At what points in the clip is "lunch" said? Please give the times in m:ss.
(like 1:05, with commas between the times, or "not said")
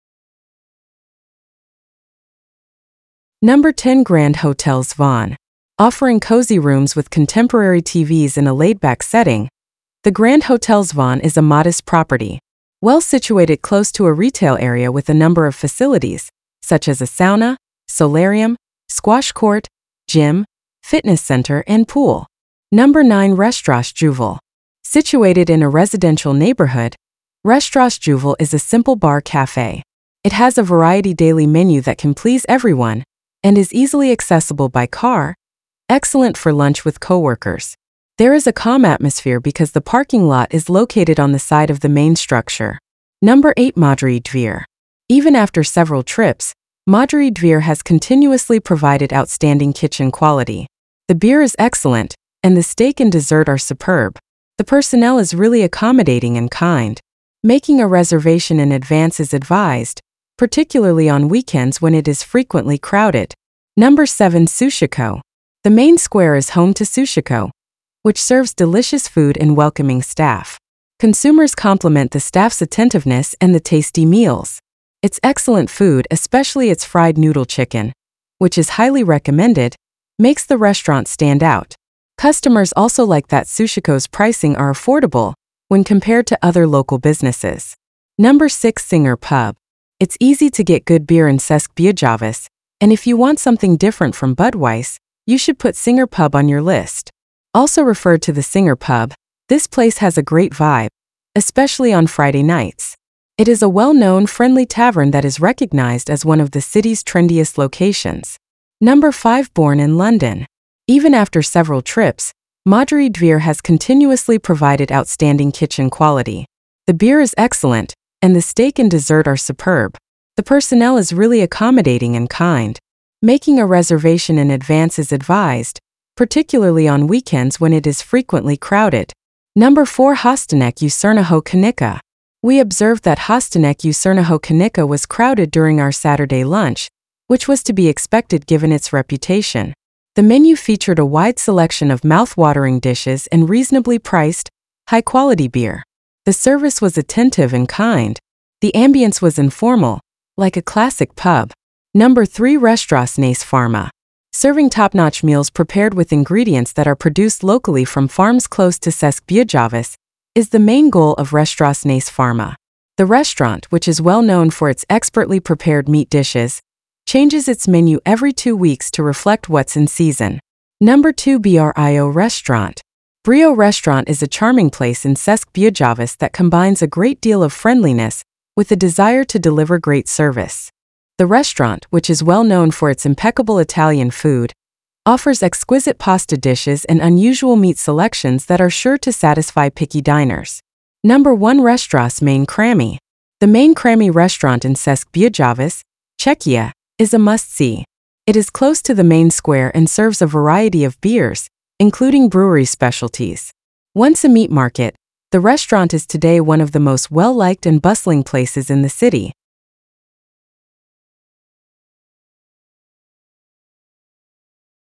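0:36, 2:16.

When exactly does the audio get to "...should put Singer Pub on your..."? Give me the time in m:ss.
1:35.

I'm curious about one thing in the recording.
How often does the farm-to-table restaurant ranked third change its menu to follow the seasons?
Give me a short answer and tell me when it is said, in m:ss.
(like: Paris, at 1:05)
every two weeks, at 2:48.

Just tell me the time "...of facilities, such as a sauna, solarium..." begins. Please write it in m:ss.
0:15.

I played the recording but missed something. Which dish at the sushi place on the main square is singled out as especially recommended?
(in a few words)
fried noodle chicken.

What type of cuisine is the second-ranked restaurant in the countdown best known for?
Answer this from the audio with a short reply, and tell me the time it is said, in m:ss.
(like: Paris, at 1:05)
Italian, at 3:03.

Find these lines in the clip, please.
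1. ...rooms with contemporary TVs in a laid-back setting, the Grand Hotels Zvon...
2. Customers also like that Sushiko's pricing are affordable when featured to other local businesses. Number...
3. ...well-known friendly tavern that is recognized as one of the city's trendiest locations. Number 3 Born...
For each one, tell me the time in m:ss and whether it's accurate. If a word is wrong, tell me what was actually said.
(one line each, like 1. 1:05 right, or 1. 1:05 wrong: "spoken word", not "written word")
1. 0:06 right
2. 1:22 wrong: "compared", not "featured"
3. 1:43 wrong: "5", not "3".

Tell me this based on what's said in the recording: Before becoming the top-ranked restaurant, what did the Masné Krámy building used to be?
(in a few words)
a meat market.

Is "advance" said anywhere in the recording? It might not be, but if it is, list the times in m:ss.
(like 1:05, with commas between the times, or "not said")
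0:58, 2:04.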